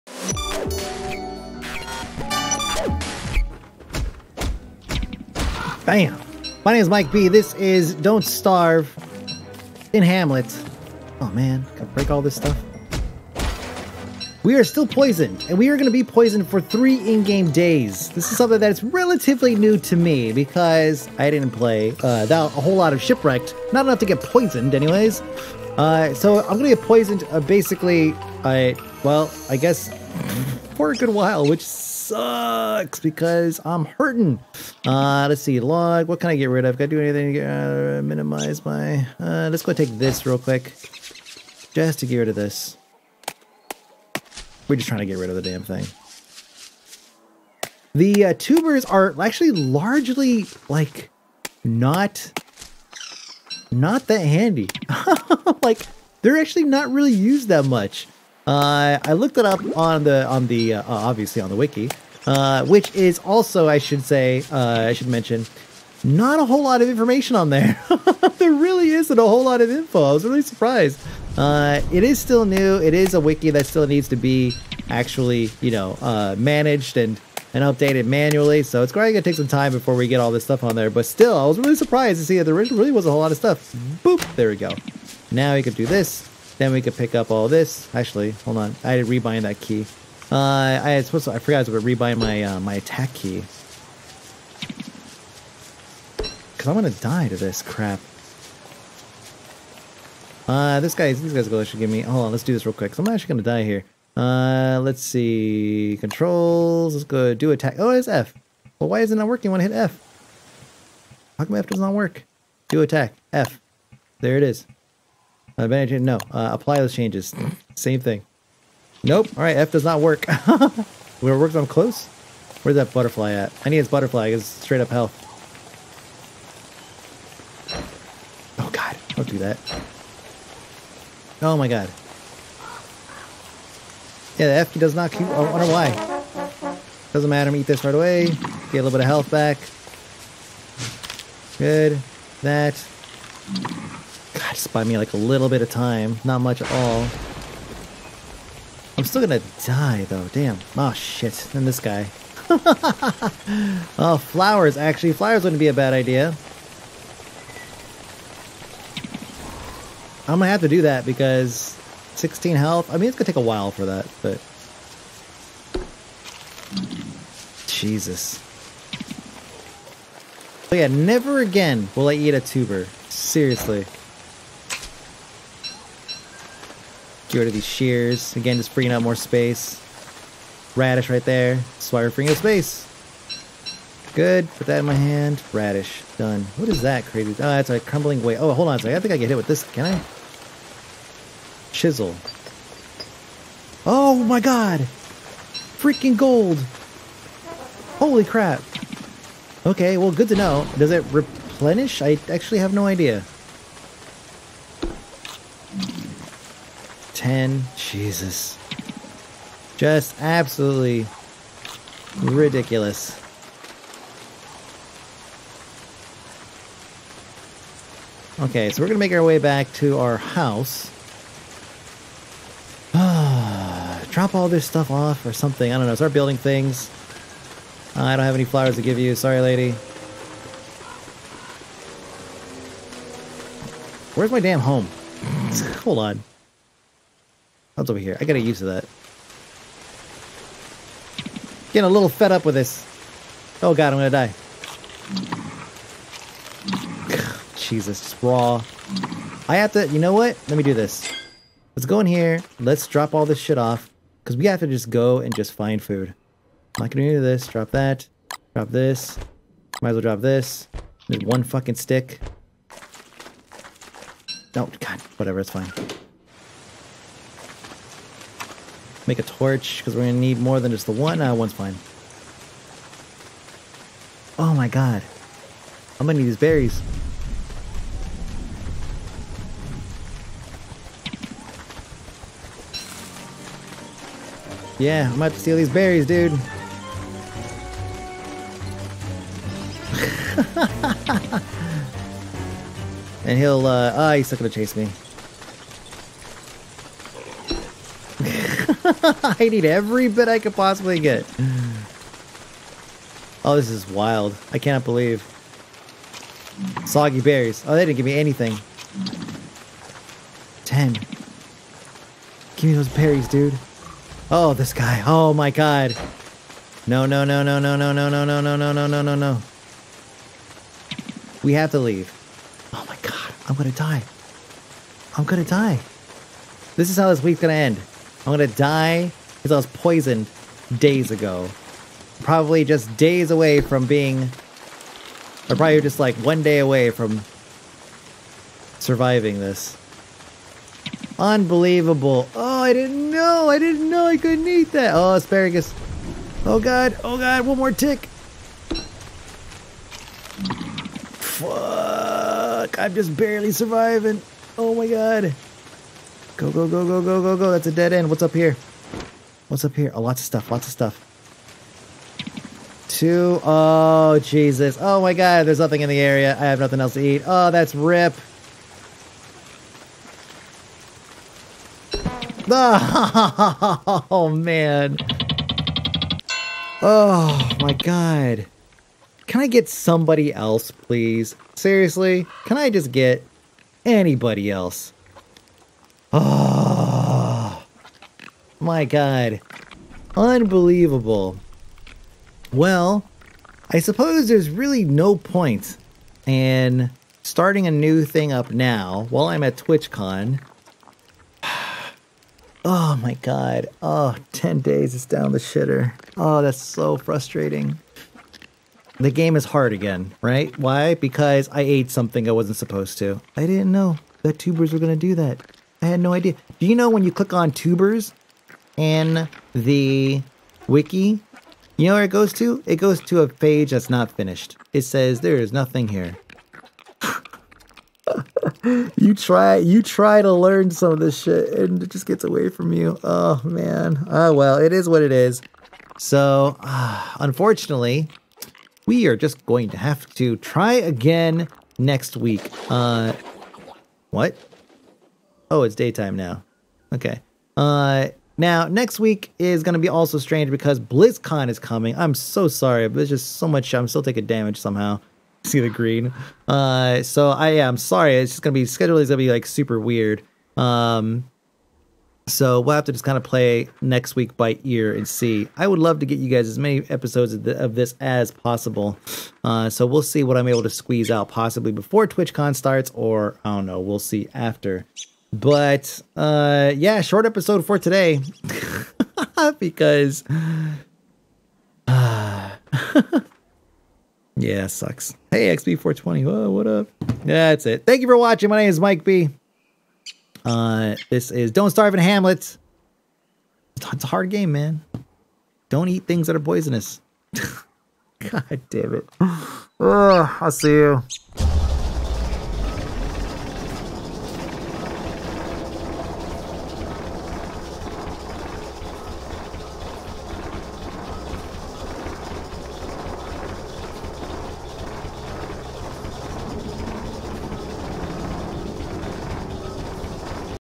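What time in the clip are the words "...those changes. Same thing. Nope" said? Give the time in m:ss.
1:56.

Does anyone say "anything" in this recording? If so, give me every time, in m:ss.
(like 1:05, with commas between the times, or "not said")
0:37, 5:08.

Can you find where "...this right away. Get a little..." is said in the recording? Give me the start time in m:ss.
2:17.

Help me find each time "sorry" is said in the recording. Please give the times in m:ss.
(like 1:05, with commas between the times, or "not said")
3:49, 7:32, 7:37.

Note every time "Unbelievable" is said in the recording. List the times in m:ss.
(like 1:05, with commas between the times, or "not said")
5:41, 6:30.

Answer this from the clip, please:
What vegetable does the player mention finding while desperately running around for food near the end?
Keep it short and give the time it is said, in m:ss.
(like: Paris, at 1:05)
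Asparagus, at 5:45.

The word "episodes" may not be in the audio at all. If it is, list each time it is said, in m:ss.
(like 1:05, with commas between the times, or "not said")
7:46, 7:57.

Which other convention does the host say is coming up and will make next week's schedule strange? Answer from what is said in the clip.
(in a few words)
BlizzCon.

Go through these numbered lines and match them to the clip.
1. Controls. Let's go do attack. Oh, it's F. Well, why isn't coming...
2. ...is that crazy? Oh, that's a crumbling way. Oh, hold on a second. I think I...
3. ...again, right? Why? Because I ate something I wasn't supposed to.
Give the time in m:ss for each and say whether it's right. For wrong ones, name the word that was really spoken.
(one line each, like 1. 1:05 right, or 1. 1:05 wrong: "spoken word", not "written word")
1. 1:45 wrong: "working", not "coming"
2. 3:06 right
3. 6:49 right.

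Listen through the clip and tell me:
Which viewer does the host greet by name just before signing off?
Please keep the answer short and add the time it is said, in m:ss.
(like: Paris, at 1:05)
XB420, at 8:05.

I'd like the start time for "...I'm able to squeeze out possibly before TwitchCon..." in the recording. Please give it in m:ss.
7:50.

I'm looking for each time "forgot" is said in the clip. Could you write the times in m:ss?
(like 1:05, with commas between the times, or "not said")
1:31.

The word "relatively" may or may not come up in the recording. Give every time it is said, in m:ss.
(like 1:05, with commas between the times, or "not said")
0:18.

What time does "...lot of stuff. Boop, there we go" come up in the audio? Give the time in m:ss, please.
1:23.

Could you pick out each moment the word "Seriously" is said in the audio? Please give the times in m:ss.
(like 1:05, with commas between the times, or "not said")
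2:53, 6:21.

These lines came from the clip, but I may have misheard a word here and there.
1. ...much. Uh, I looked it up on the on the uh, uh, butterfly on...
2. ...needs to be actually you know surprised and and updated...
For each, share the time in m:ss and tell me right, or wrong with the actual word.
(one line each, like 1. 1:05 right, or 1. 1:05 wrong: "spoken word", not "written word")
1. 0:57 wrong: "obviously", not "butterfly"
2. 1:13 wrong: "managed", not "surprised".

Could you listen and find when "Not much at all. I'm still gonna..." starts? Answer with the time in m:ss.
2:26.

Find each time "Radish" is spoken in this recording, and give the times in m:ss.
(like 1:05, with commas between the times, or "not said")
3:00, 3:05.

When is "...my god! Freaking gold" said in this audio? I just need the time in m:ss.
3:14.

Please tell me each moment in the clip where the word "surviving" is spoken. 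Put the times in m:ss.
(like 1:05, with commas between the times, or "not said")
5:38, 5:53.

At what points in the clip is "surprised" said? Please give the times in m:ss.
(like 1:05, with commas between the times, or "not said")
1:10, 1:21.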